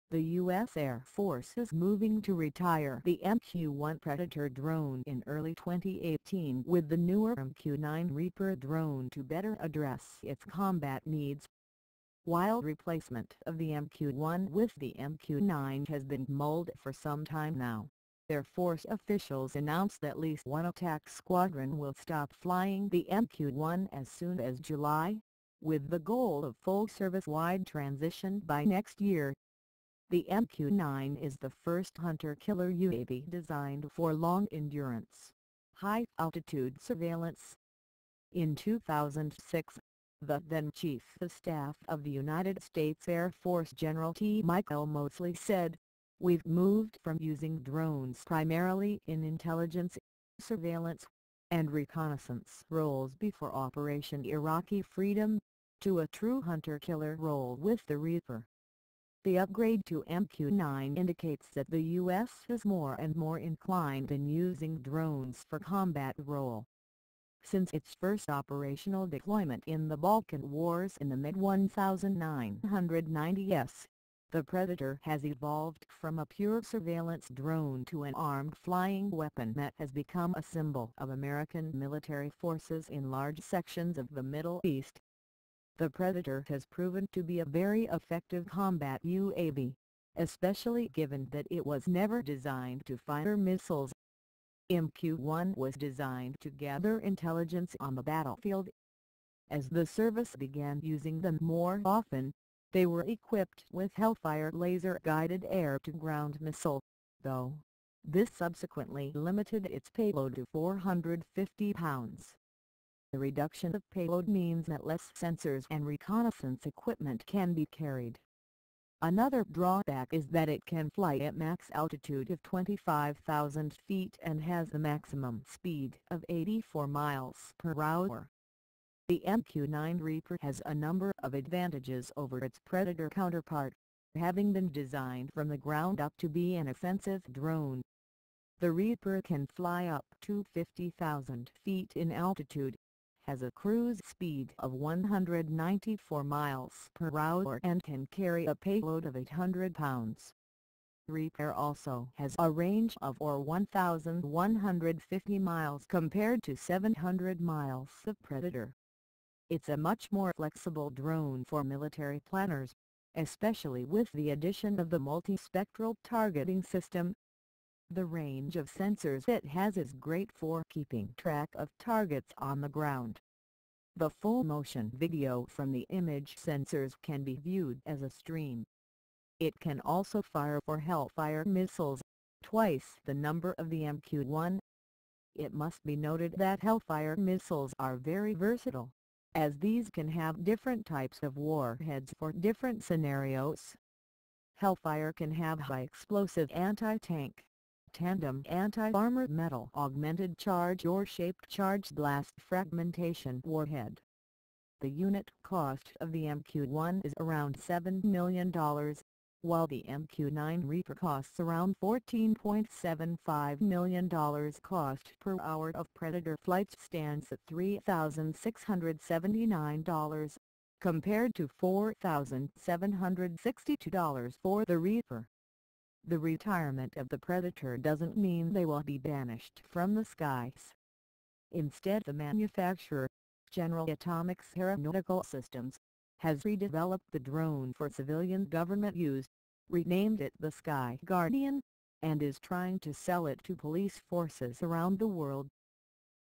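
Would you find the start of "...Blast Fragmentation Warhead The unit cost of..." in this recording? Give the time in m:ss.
3:21.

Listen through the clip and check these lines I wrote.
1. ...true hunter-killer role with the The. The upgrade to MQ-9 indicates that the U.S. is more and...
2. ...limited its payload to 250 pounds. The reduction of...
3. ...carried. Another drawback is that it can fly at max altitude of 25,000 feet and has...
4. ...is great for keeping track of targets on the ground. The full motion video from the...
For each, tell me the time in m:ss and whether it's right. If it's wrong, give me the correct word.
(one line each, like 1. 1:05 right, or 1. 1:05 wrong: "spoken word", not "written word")
1. 0:56 wrong: "Reaper", not "The"
2. 1:49 wrong: "450", not "250"
3. 1:57 right
4. 2:49 right.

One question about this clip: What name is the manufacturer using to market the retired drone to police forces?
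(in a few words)
Sky Guardian.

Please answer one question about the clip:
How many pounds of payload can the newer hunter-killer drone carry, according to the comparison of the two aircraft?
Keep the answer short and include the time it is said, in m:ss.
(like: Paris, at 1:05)
800 pounds, at 2:29.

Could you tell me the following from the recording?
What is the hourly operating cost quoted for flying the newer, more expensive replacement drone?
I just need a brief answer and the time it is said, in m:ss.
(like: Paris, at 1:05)
$4,762, at 3:41.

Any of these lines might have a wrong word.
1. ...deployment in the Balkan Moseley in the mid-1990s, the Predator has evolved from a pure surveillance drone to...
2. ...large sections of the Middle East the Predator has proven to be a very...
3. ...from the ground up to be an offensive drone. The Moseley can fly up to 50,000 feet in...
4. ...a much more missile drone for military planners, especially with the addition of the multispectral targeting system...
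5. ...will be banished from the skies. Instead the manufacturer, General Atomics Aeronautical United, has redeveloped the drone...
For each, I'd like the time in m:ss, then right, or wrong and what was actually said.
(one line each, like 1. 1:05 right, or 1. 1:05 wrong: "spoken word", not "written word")
1. 1:09 wrong: "Wars", not "Moseley"
2. 1:23 right
3. 2:15 wrong: "Reaper", not "Moseley"
4. 2:39 wrong: "flexible", not "missile"
5. 3:48 wrong: "Systems", not "United".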